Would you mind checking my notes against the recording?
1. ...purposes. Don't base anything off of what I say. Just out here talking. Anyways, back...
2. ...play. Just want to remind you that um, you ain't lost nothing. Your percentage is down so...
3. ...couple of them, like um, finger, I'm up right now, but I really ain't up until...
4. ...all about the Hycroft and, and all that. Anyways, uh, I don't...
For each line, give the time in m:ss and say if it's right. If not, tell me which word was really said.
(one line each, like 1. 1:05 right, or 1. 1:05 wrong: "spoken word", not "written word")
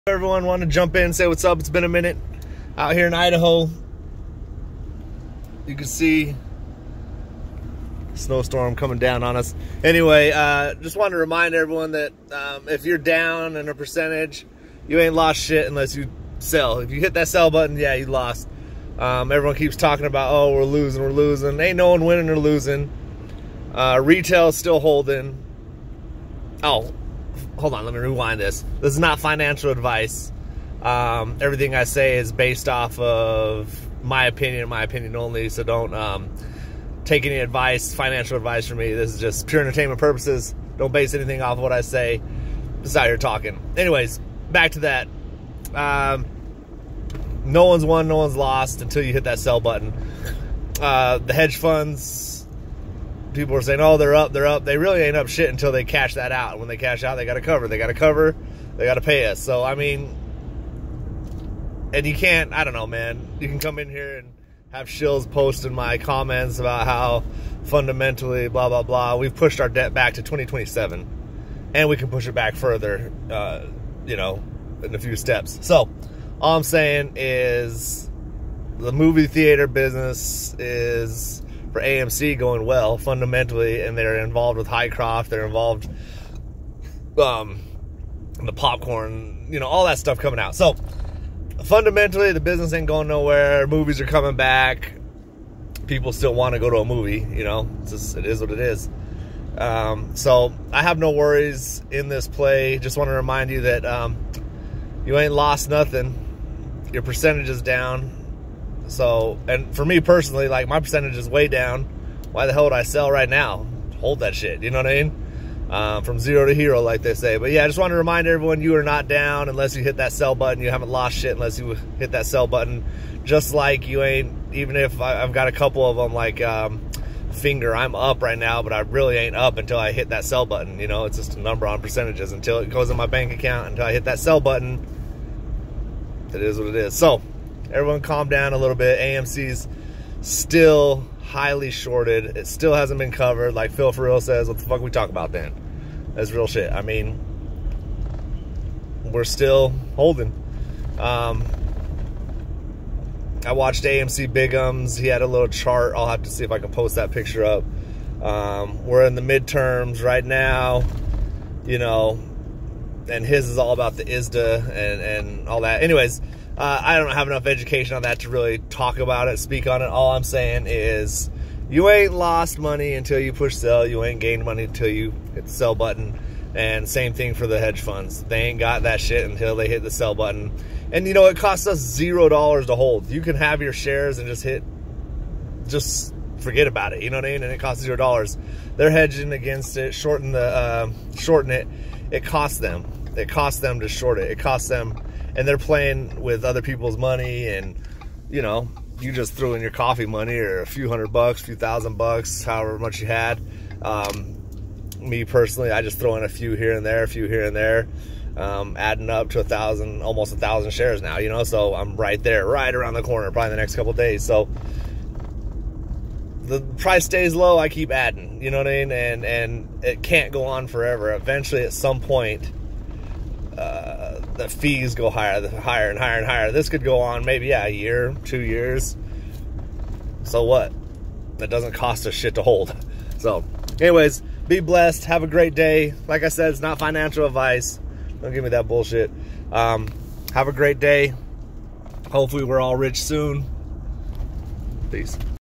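1. 0:39 right
2. 1:42 right
3. 2:05 right
4. 2:43 wrong: "ISDA", not "Hycroft".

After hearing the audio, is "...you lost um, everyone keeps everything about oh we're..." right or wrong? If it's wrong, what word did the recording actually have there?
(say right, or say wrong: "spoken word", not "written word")
wrong: "talking", not "everything".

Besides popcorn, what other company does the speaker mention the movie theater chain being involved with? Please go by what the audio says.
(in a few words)
Hycroft.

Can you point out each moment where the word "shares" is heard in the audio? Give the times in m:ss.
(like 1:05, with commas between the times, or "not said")
3:03, 3:30.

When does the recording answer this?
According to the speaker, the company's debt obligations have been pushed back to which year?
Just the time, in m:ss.
1:10.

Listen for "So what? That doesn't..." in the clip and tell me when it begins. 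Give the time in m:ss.
3:50.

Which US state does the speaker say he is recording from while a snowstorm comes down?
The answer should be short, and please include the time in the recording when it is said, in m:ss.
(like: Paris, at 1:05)
Idaho, at 0:03.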